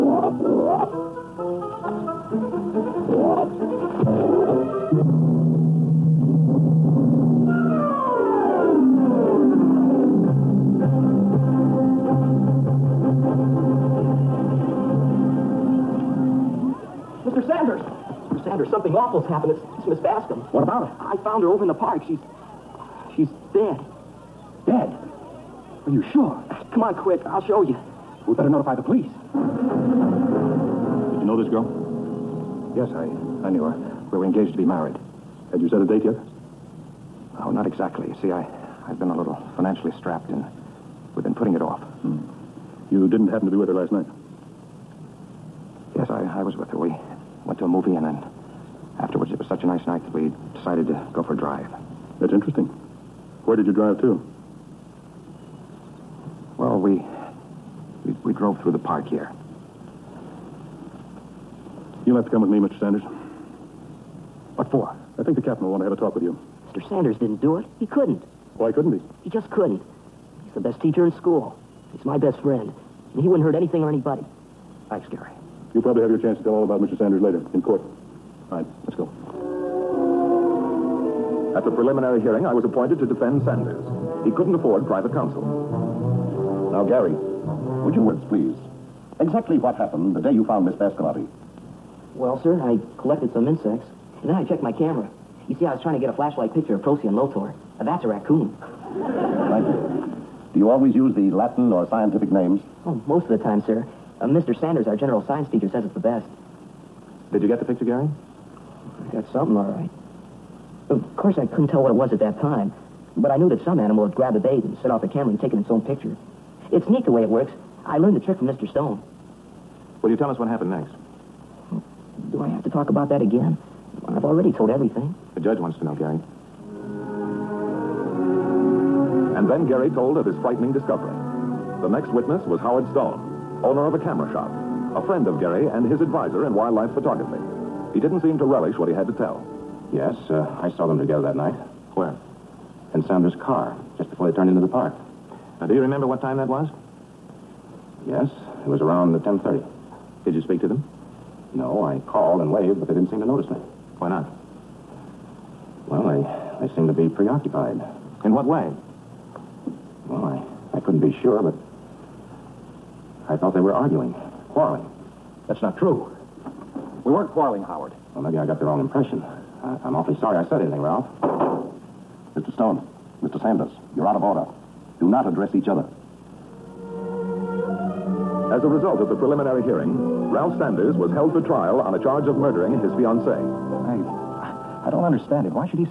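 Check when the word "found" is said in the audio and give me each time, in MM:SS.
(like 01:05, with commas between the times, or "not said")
00:21, 01:30.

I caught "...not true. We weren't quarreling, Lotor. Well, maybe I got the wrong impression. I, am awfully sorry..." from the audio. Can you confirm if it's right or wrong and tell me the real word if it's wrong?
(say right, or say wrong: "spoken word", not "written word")
wrong: "Howard", not "Lotor".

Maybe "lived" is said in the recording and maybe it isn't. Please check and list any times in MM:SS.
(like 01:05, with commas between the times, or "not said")
not said.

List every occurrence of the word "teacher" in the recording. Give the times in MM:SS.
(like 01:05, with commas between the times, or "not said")
01:10, 01:45.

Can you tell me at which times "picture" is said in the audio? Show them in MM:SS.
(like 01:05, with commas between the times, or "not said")
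01:36, 01:47, 01:55.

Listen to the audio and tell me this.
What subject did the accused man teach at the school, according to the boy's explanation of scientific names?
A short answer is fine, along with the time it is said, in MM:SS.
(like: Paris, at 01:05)
General science, at 01:44.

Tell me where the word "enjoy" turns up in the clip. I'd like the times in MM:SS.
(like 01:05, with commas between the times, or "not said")
not said.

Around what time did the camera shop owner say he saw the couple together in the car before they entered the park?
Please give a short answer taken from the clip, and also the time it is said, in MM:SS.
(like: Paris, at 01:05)
10:30, at 02:29.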